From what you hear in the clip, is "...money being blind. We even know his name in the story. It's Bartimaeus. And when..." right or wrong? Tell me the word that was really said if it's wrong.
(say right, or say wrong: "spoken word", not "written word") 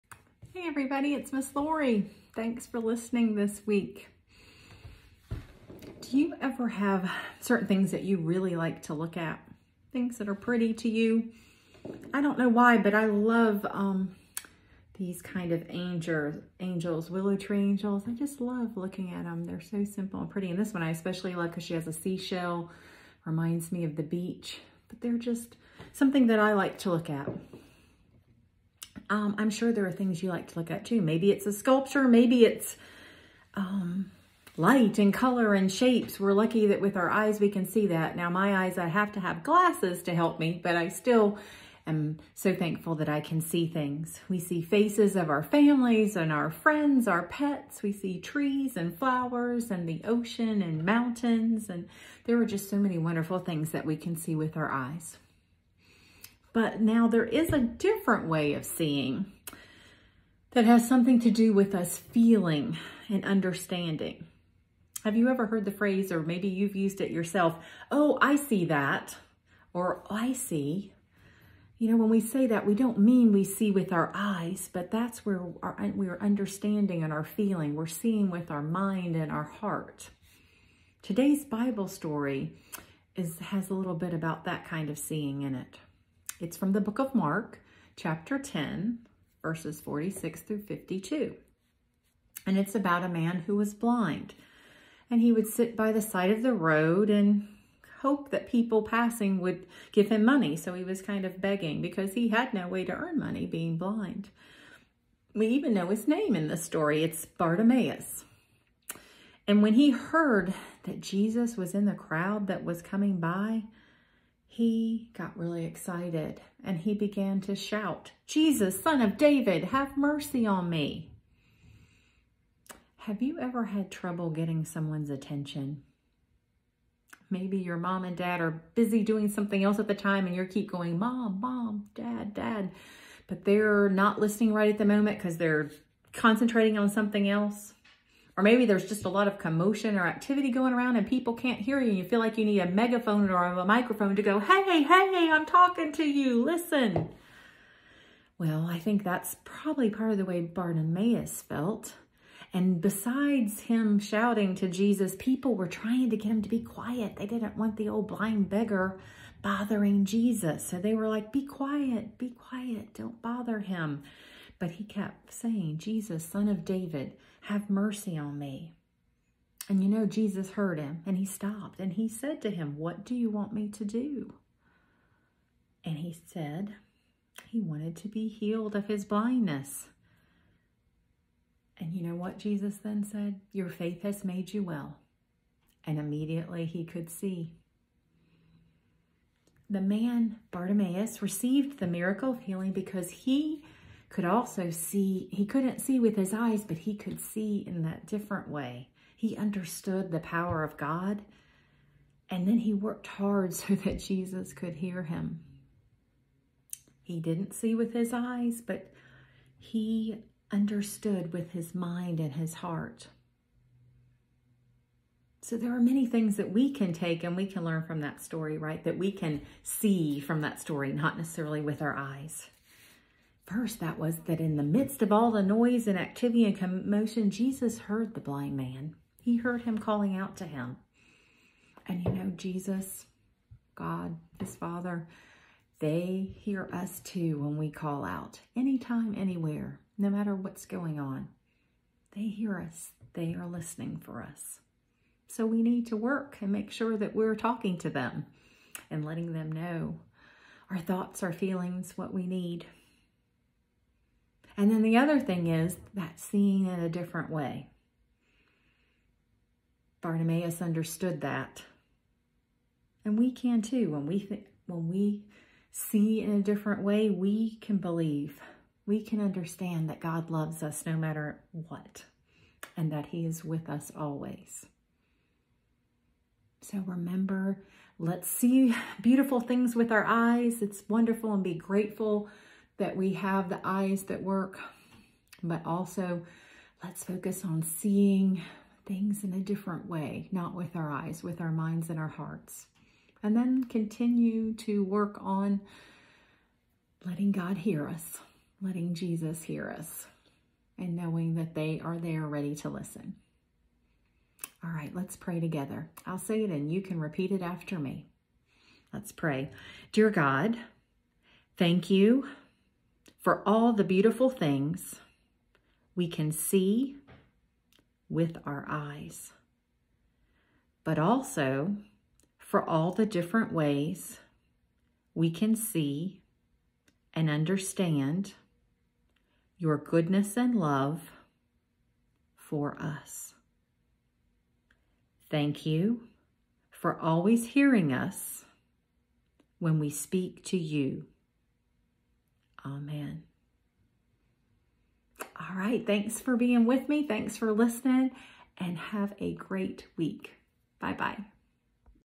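right.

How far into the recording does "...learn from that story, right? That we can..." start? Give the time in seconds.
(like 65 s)
217 s.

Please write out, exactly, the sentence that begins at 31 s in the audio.
Maybe it's a sculpture, maybe it's um, light and color and shapes.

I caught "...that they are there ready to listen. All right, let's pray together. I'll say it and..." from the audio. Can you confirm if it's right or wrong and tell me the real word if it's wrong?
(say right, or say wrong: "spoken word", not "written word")
right.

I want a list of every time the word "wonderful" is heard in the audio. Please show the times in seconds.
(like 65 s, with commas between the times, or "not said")
52 s, 280 s.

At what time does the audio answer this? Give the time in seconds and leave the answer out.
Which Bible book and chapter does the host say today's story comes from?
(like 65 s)
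87 s.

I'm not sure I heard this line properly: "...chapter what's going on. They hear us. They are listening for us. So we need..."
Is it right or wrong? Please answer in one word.
wrong.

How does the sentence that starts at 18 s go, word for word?
I just love looking at them.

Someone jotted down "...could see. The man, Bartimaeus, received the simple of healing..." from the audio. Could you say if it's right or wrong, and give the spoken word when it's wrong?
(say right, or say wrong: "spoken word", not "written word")
wrong: "miracle", not "simple".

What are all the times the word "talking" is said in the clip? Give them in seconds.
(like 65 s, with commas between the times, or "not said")
145 s, 247 s.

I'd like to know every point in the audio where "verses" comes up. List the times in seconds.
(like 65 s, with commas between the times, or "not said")
89 s, 223 s.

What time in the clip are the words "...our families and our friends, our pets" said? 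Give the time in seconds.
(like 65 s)
45 s.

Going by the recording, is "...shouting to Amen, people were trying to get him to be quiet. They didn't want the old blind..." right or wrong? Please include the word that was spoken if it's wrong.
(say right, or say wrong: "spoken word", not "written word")
wrong: "Jesus", not "Amen".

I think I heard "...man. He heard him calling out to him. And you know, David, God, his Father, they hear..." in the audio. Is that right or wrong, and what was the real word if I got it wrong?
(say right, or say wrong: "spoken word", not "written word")
wrong: "Jesus", not "David".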